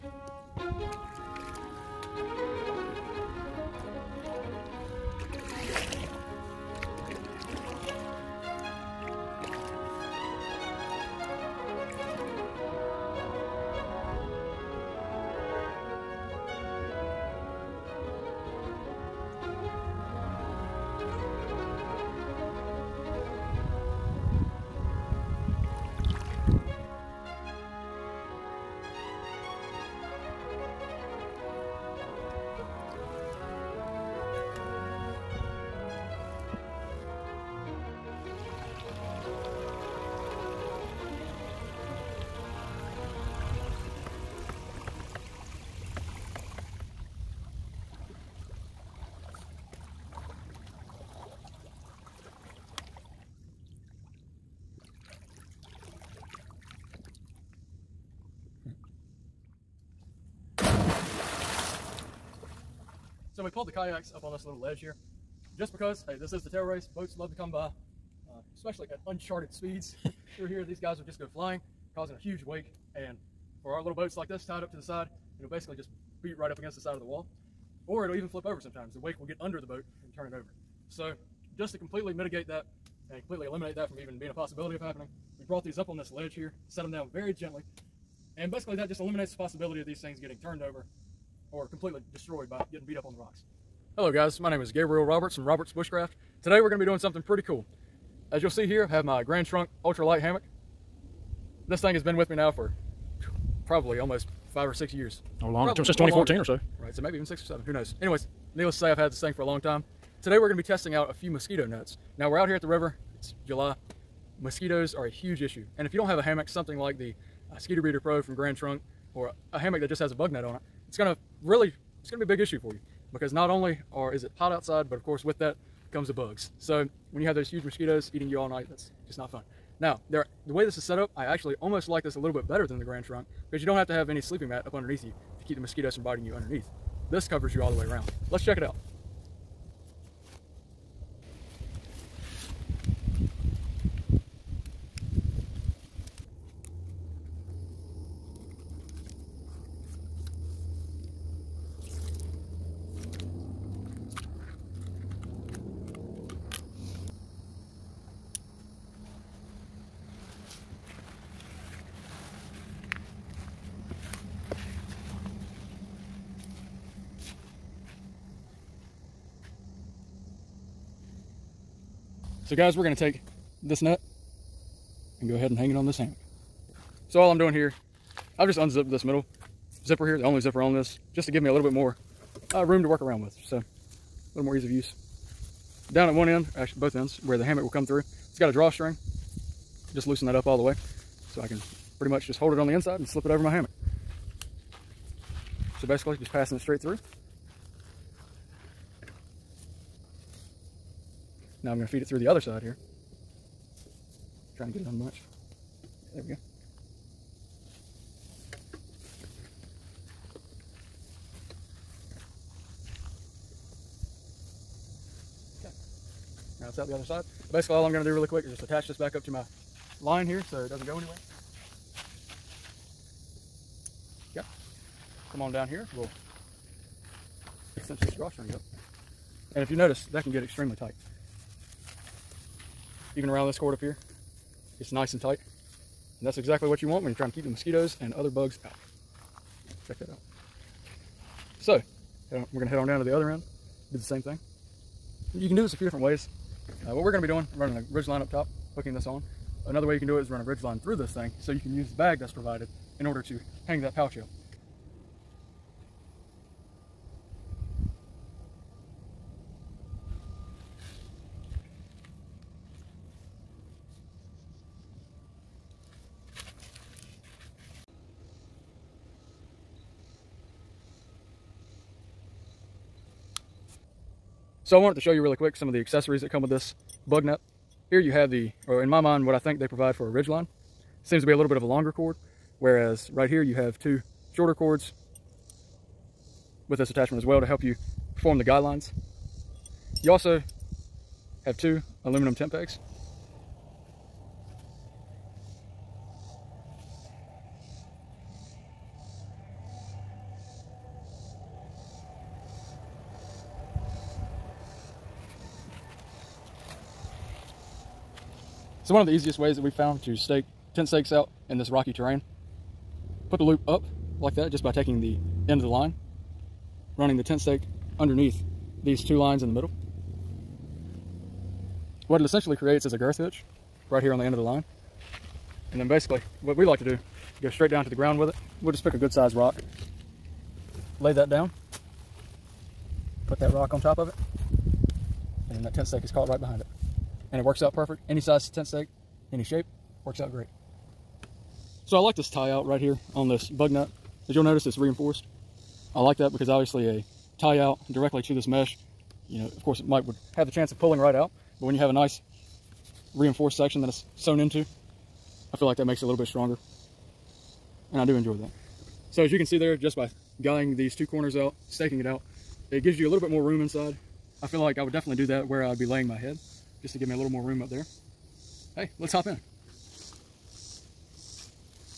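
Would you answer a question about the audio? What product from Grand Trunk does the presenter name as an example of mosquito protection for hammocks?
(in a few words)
Skeeter Beeter Pro.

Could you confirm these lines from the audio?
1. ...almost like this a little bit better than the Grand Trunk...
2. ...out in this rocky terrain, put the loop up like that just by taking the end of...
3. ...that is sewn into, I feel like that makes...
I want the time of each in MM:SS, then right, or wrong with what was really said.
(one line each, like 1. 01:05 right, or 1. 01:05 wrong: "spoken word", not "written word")
1. 02:11 right
2. 05:11 right
3. 05:53 right.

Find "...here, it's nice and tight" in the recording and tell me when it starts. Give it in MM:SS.
03:53.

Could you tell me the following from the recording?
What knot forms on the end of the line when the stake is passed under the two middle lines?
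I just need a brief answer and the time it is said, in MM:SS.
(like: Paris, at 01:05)
Girth hitch, at 05:22.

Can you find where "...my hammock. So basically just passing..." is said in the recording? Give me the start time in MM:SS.
03:13.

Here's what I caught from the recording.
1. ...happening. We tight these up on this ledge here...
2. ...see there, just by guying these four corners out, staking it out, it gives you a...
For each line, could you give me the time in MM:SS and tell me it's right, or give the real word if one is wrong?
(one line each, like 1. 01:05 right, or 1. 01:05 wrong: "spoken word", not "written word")
1. 01:24 wrong: "brought", not "tight"
2. 05:59 wrong: "two", not "four".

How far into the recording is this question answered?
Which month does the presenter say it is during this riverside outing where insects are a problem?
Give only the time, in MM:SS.
01:53.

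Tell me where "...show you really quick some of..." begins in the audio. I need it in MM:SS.
04:35.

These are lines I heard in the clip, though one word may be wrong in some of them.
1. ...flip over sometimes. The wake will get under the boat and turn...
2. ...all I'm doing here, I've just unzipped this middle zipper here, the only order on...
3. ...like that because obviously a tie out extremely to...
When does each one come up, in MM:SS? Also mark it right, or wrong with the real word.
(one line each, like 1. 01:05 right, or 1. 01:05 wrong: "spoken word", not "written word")
1. 01:18 right
2. 02:57 wrong: "zipper", not "order"
3. 05:46 wrong: "directly", not "extremely".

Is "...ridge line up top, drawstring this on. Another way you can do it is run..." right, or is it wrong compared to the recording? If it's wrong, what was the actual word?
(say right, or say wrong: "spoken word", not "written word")
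wrong: "hooking", not "drawstring".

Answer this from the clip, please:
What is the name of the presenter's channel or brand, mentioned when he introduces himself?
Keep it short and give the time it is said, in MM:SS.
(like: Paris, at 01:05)
Roberts Bushcraft, at 01:35.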